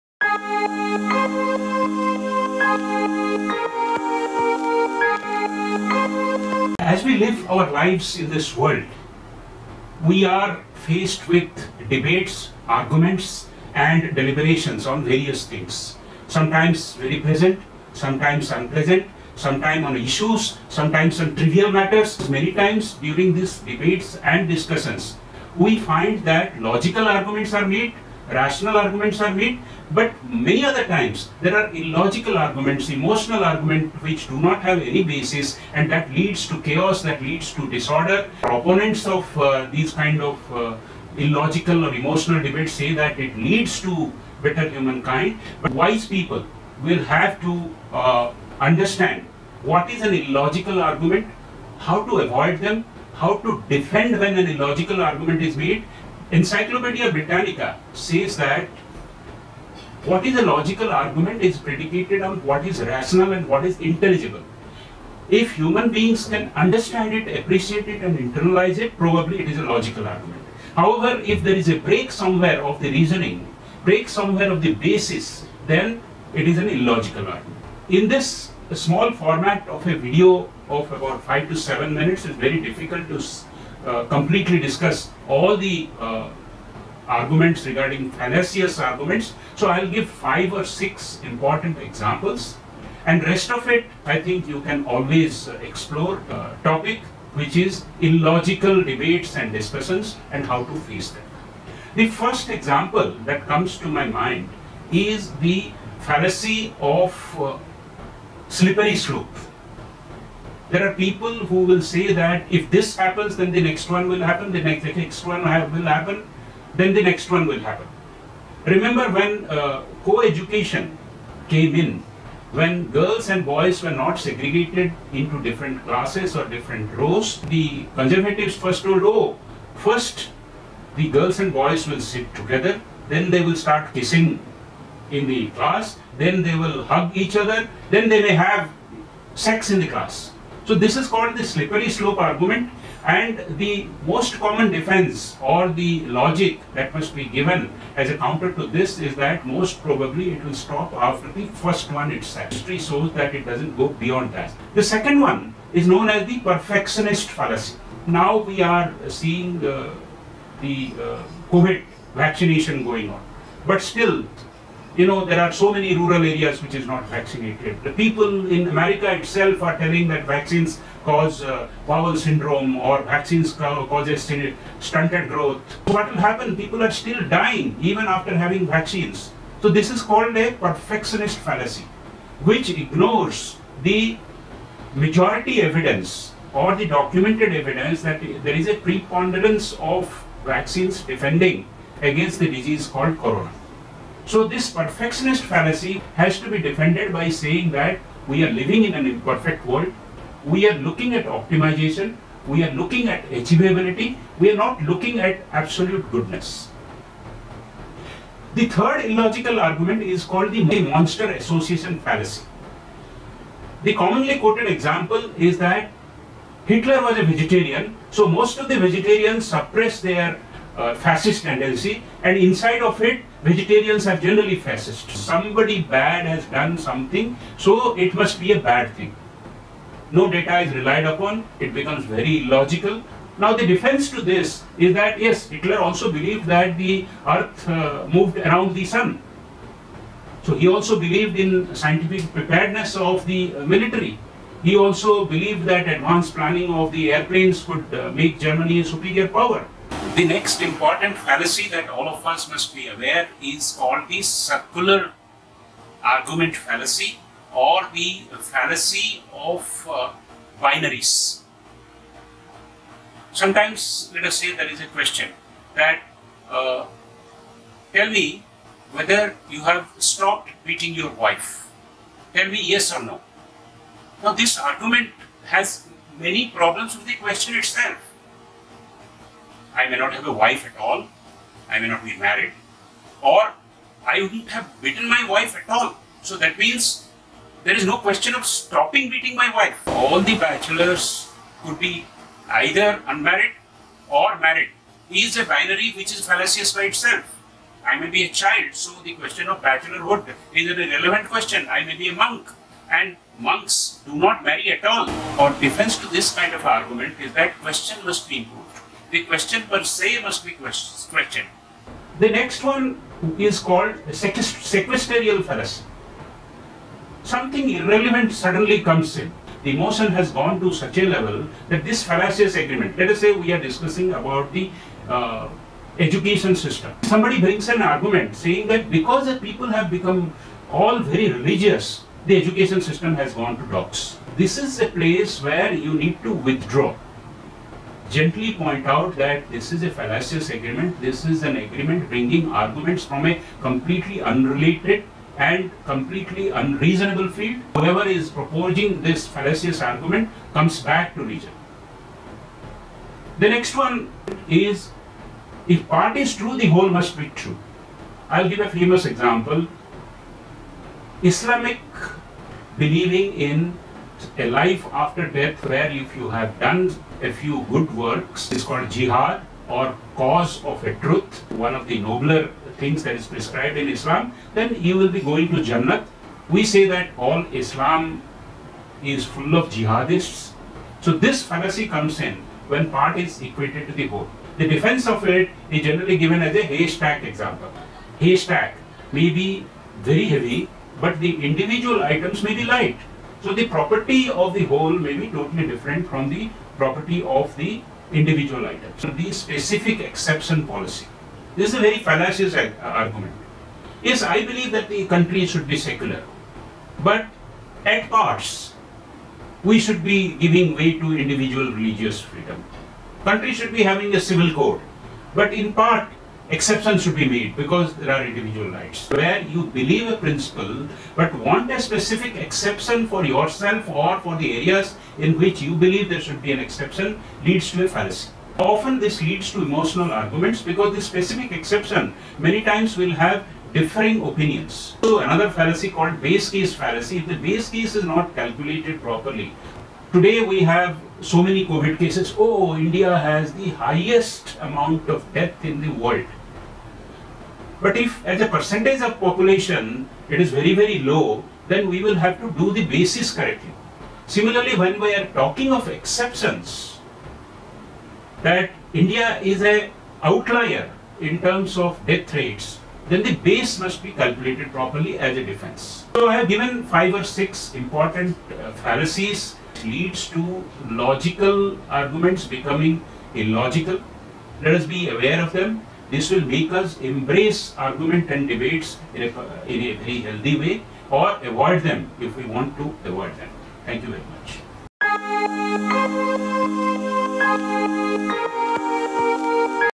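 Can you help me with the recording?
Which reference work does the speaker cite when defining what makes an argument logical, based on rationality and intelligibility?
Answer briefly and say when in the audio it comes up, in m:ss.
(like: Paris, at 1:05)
Encyclopedia Britannica, at 0:56.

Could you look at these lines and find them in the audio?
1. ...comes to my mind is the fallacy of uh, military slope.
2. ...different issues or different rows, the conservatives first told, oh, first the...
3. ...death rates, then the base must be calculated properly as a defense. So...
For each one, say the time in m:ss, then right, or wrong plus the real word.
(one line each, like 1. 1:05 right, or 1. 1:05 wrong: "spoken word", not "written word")
1. 1:43 wrong: "slippery", not "military"
2. 2:05 wrong: "classes", not "issues"
3. 7:42 right.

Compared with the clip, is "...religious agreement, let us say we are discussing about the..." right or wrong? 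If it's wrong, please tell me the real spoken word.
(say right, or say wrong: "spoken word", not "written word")
wrong: "fallacious", not "religious".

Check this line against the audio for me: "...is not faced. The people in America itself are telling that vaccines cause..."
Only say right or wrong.
wrong.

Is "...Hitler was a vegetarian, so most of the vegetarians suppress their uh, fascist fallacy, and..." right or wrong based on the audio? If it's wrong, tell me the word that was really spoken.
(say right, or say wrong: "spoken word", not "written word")
wrong: "tendency", not "fallacy".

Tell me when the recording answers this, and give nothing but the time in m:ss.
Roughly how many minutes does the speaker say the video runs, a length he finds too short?
1:21.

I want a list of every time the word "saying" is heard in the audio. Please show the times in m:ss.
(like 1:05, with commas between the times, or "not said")
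3:17, 5:28.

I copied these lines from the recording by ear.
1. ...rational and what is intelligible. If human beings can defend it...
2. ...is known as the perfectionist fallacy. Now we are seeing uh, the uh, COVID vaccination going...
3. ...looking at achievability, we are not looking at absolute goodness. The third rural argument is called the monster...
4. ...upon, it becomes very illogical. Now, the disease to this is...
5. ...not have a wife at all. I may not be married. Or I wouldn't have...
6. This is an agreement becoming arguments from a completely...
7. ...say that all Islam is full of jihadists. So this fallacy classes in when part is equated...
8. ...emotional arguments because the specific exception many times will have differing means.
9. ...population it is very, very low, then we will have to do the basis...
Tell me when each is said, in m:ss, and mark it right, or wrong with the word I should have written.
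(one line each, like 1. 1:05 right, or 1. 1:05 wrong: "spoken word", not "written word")
1. 1:02 wrong: "understand", not "defend"
2. 2:35 right
3. 3:22 wrong: "illogical", not "rural"
4. 3:51 wrong: "defense", not "disease"
5. 4:39 right
6. 5:41 wrong: "bringing", not "becoming"
7. 6:16 wrong: "comes", not "classes"
8. 7:09 wrong: "opinions", not "means"
9. 7:29 right.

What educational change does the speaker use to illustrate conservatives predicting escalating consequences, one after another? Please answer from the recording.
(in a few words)
co-education.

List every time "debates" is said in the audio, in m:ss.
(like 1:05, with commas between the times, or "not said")
0:11, 0:23, 0:42, 1:38, 7:58.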